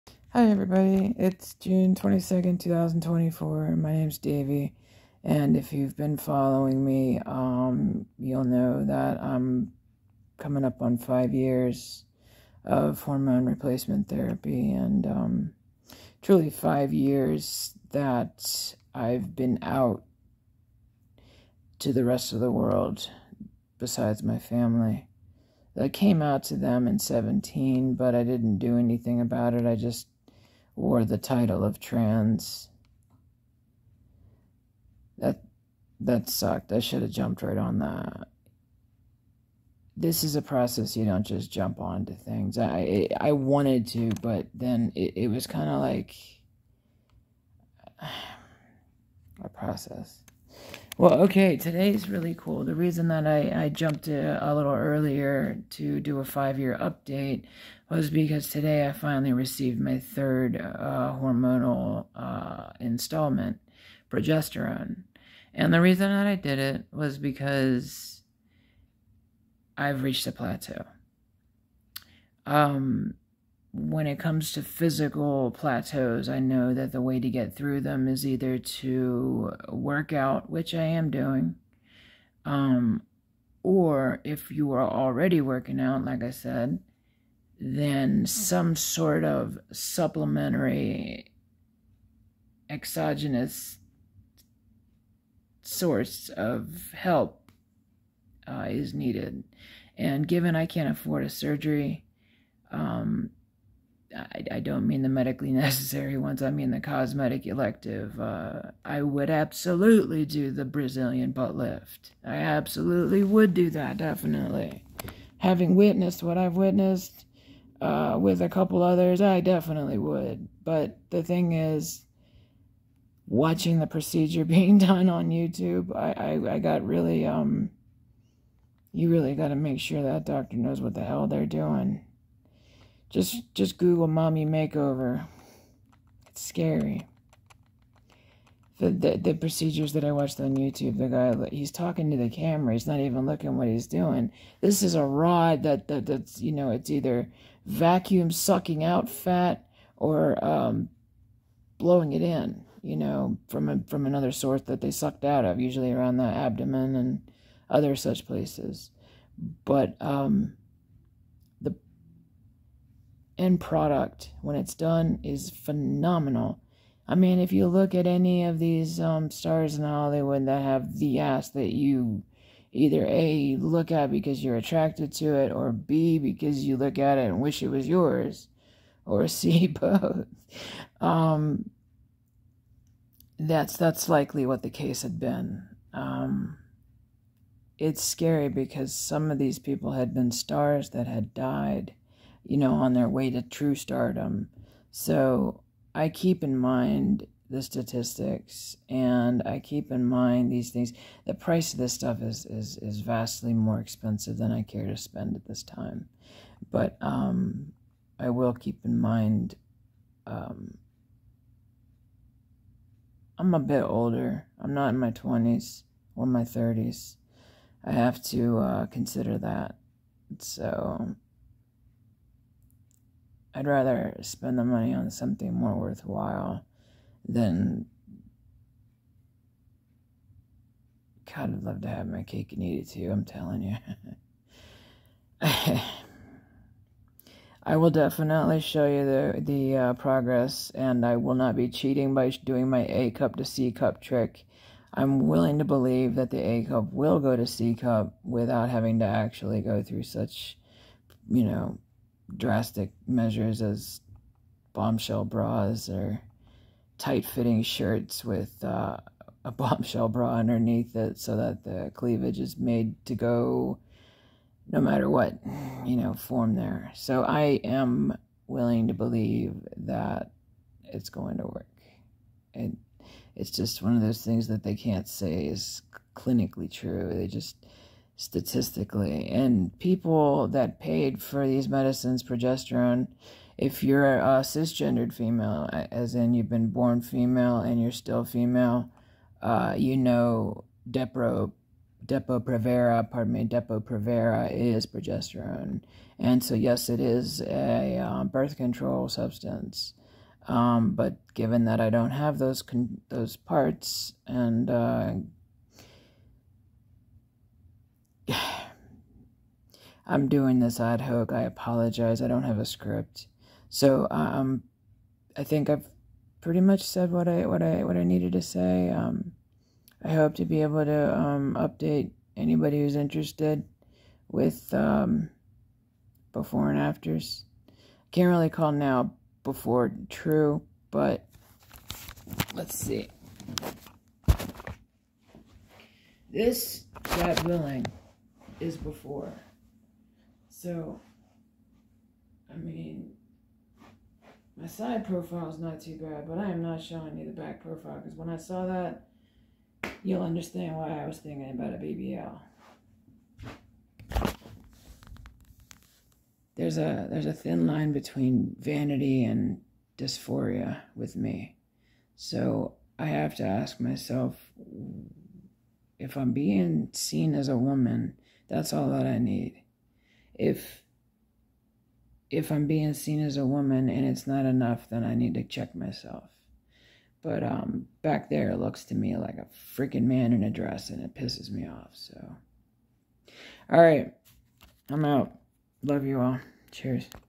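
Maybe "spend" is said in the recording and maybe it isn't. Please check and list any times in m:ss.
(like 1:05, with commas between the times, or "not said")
3:24, 3:44.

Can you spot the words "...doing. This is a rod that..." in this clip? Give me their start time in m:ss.
2:23.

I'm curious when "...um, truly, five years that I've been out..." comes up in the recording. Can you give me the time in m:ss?
0:15.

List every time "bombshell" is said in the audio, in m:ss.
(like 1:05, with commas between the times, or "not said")
4:14, 4:19.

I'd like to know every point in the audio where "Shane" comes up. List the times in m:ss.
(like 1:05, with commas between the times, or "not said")
not said.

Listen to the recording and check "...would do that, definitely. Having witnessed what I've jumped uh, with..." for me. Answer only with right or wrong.
wrong.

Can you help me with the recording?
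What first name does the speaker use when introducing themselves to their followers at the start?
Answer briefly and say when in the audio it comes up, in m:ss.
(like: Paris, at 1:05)
Davie, at 0:04.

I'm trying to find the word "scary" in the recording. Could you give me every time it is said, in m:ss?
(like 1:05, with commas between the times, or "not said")
2:16, 3:08.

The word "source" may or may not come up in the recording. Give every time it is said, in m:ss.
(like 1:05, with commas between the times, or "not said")
1:35, 2:34.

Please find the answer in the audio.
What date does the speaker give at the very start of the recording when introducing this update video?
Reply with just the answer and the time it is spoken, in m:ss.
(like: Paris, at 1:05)
June 22, 2024, at 0:01.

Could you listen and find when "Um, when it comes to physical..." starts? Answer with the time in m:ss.
1:12.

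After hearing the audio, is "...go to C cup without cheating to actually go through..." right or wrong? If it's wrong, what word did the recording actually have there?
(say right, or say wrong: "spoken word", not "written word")
wrong: "having", not "cheating".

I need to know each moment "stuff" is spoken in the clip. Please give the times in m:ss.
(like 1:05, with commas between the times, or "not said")
3:21.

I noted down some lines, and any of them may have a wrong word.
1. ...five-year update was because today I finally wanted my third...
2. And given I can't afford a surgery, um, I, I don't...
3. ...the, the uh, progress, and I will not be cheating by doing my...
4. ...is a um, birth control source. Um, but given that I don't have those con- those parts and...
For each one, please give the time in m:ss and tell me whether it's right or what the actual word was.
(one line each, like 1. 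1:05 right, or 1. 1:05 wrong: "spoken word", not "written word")
1. 0:56 wrong: "received", not "wanted"
2. 1:39 right
3. 3:59 right
4. 4:56 wrong: "substance", not "source".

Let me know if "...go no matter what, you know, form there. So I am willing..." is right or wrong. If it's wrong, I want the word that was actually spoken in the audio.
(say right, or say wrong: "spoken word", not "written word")
right.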